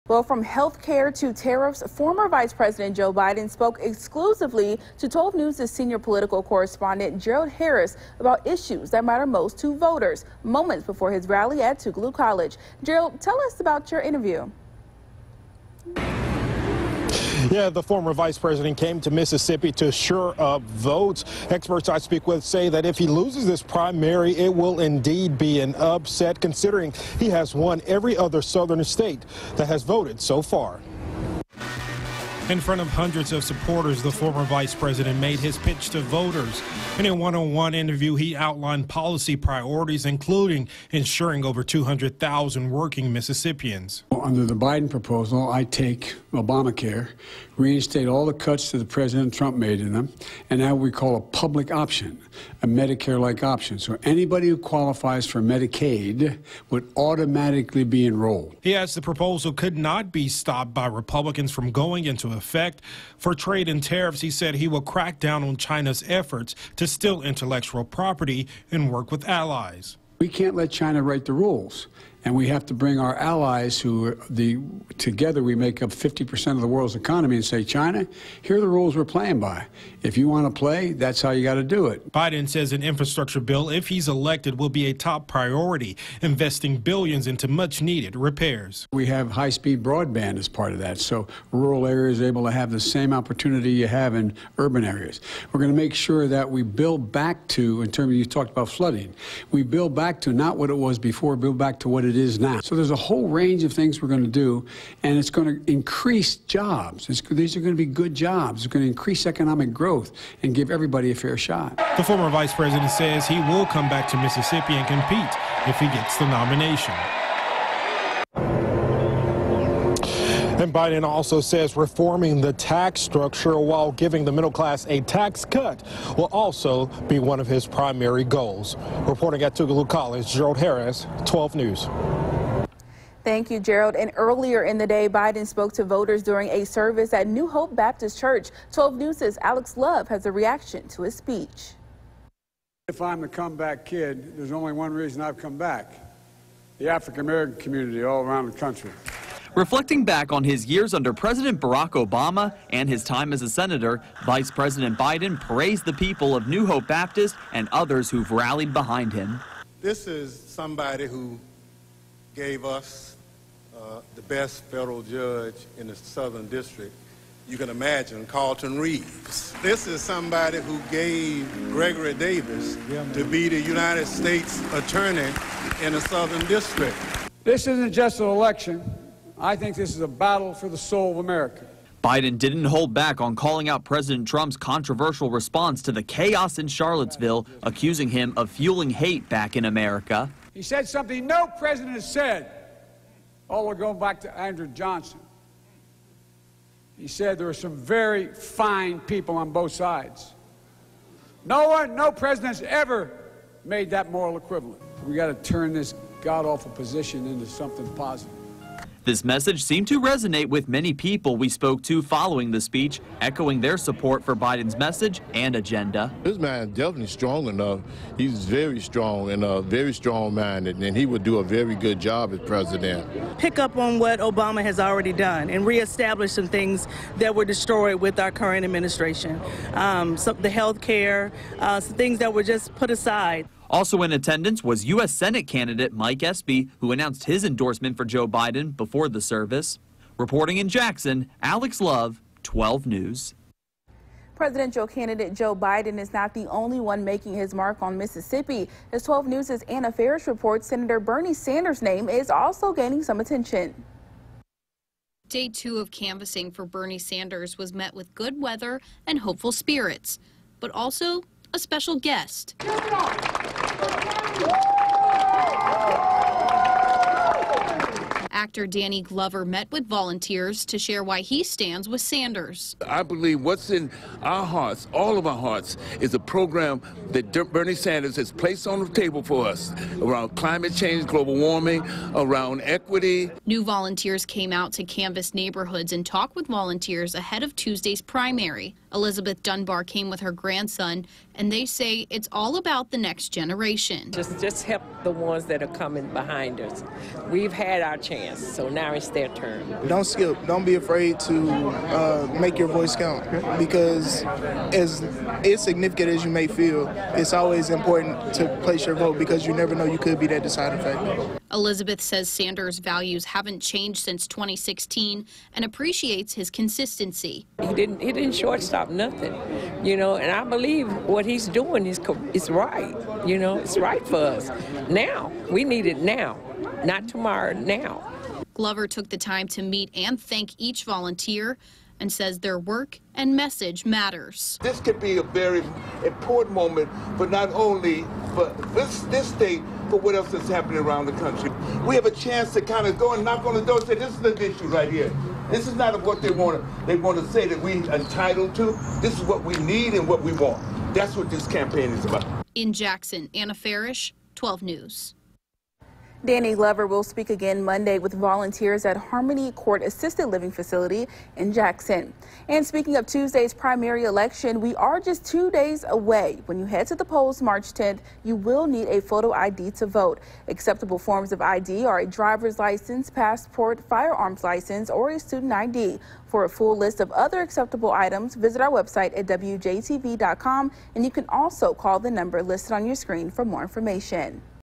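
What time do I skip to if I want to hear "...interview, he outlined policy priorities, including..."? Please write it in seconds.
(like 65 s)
37 s.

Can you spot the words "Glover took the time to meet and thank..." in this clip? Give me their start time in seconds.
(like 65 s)
328 s.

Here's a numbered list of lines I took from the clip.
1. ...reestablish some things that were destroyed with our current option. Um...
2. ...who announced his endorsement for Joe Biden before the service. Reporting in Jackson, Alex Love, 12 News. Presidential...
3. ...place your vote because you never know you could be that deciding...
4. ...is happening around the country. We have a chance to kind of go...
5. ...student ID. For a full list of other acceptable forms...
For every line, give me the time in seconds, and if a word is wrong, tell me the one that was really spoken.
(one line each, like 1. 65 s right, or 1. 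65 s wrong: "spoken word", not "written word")
1. 225 s wrong: "administration", not "option"
2. 236 s right
3. 308 s right
4. 340 s right
5. 375 s wrong: "items", not "forms".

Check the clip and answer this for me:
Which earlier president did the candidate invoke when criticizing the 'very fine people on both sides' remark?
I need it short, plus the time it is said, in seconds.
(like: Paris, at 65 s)
Andrew Johnson, at 194 s.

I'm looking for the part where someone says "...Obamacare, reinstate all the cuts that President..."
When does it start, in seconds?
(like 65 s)
46 s.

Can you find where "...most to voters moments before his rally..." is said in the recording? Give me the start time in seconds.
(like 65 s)
9 s.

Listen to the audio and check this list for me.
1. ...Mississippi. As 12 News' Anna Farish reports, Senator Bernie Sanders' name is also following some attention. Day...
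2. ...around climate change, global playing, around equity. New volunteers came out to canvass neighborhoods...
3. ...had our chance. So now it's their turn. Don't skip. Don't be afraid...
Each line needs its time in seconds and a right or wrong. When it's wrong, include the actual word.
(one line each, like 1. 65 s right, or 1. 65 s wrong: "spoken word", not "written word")
1. 247 s wrong: "gaining", not "following"
2. 280 s wrong: "warming", not "playing"
3. 297 s right.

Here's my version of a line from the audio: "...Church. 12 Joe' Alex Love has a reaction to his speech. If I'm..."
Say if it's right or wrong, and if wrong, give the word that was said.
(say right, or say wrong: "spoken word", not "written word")
wrong: "News", not "Joe".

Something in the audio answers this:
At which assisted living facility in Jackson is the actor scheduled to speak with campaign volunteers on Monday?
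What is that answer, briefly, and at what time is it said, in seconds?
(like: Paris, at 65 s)
Harmony Court, at 358 s.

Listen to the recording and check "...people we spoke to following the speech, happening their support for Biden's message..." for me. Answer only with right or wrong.
wrong.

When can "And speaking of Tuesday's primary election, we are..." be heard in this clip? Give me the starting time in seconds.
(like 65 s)
362 s.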